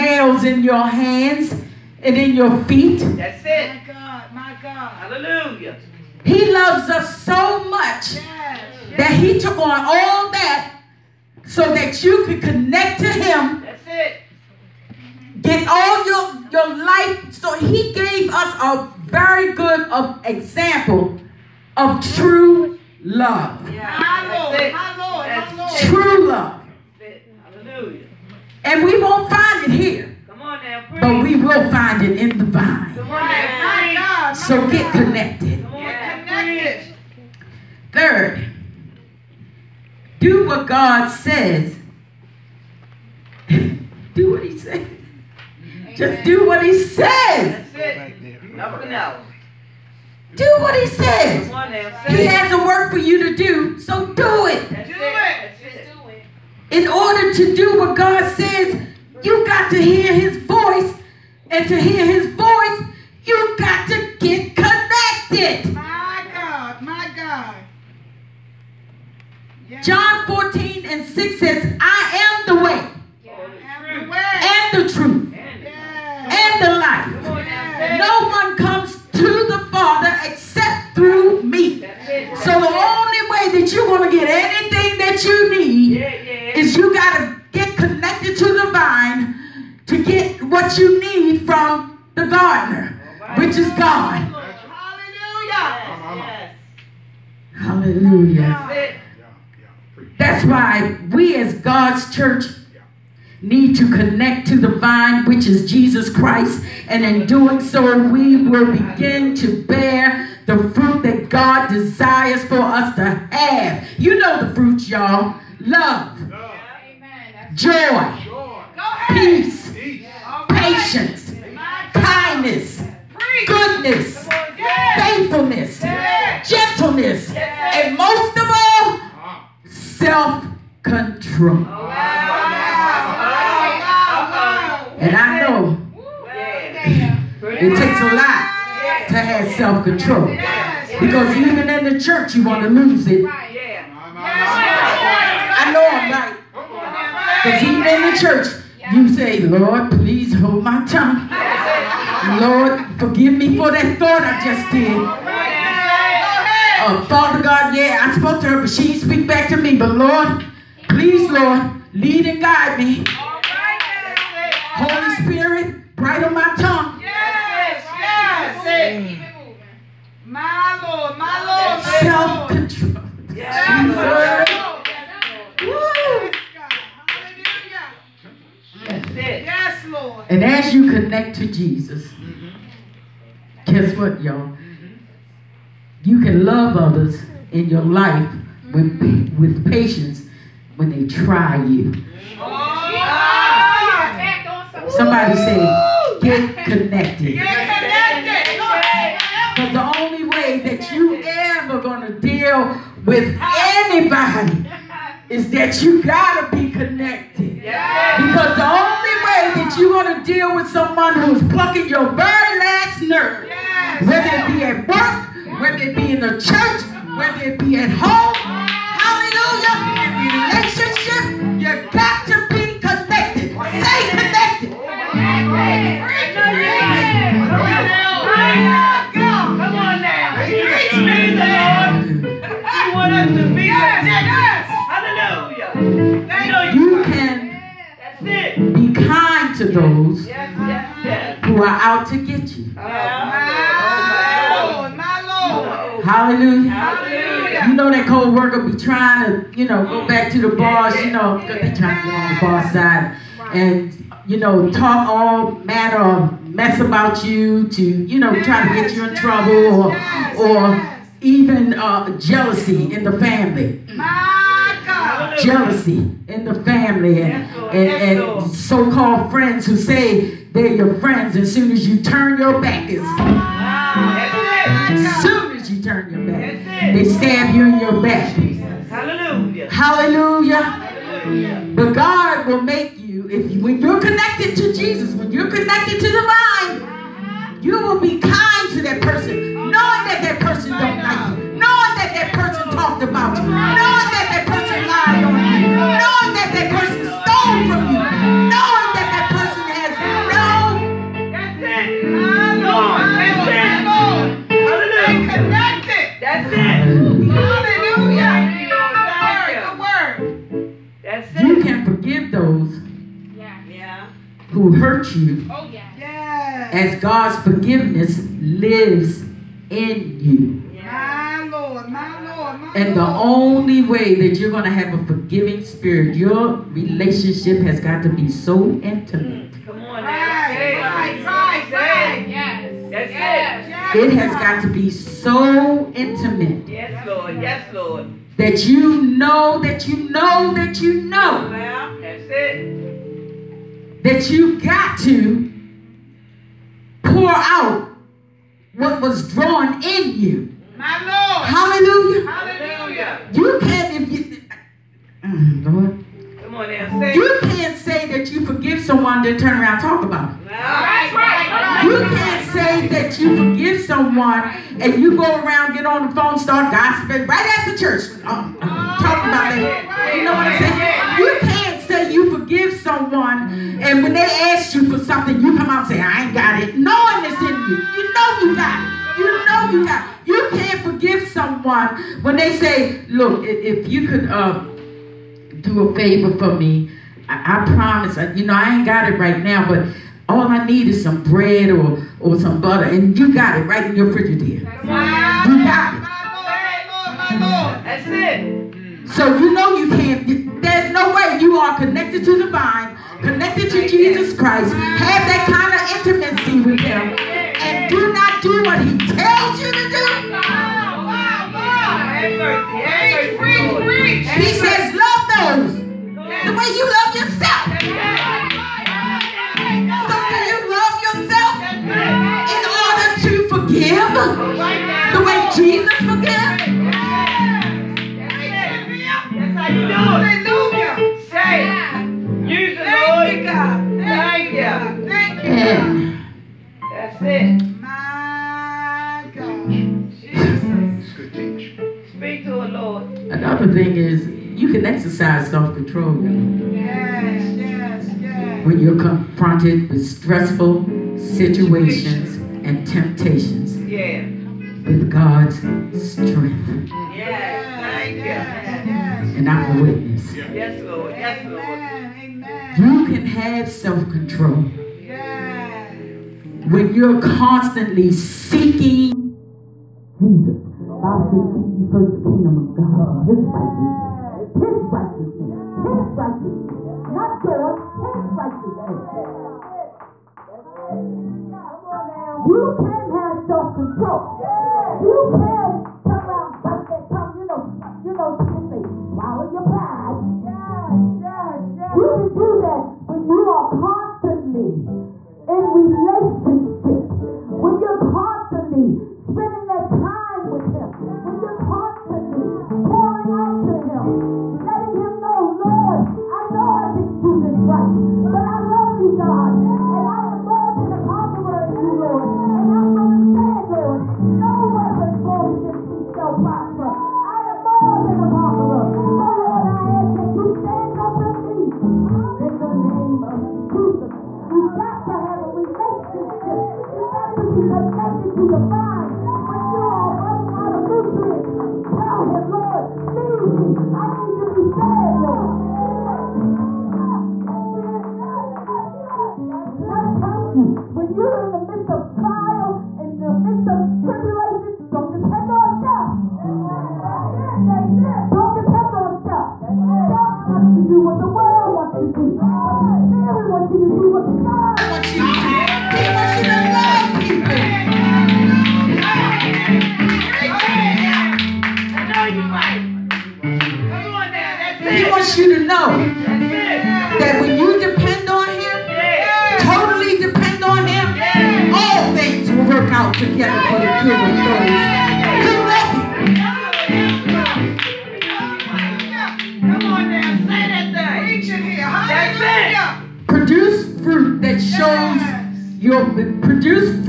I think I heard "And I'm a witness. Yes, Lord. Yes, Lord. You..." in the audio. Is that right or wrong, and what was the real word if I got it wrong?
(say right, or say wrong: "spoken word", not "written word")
right.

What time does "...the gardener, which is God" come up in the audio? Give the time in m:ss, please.
1:32.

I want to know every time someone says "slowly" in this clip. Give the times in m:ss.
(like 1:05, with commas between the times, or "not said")
not said.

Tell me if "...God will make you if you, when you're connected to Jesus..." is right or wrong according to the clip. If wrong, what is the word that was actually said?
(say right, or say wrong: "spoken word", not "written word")
right.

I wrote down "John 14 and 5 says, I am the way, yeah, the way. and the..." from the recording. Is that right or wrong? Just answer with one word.
wrong.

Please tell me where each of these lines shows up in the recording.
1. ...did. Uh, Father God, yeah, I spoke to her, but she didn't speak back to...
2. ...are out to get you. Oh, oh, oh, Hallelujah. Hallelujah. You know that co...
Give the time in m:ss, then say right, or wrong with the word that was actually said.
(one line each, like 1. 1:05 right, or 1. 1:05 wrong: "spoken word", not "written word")
1. 2:34 right
2. 4:01 right.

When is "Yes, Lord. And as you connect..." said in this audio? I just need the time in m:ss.
2:59.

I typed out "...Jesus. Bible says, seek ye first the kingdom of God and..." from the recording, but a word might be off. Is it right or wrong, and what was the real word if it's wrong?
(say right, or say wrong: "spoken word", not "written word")
right.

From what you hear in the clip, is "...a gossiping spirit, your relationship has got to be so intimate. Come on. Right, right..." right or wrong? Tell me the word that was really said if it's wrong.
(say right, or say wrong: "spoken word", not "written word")
wrong: "forgiving", not "gossiping".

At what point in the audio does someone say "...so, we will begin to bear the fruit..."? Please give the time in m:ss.
1:47.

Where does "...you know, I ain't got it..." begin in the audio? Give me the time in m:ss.
6:28.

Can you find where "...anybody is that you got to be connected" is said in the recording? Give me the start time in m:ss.
3:23.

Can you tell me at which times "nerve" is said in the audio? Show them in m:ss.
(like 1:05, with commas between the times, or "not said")
3:33.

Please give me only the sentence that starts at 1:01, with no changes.
And to hear his voice, you got to get connected.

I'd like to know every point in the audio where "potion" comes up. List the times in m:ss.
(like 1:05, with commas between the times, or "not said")
not said.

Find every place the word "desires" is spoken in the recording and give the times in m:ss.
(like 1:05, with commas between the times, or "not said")
1:51.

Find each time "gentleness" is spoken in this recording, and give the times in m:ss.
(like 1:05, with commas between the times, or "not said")
2:05.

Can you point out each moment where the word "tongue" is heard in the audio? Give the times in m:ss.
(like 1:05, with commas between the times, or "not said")
2:30, 2:46.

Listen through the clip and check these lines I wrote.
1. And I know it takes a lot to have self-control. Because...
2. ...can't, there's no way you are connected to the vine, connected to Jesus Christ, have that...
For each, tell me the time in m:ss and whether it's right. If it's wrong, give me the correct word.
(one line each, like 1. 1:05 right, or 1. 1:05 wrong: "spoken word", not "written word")
1. 2:14 right
2. 6:39 right.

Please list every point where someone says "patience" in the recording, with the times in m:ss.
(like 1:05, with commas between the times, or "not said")
2:00, 3:09.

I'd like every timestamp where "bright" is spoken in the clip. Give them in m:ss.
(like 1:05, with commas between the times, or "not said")
2:45.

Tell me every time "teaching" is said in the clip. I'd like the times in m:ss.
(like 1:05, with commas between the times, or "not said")
not said.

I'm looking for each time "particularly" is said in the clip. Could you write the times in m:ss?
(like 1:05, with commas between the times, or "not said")
not said.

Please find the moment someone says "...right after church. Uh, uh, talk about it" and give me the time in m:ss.
6:07.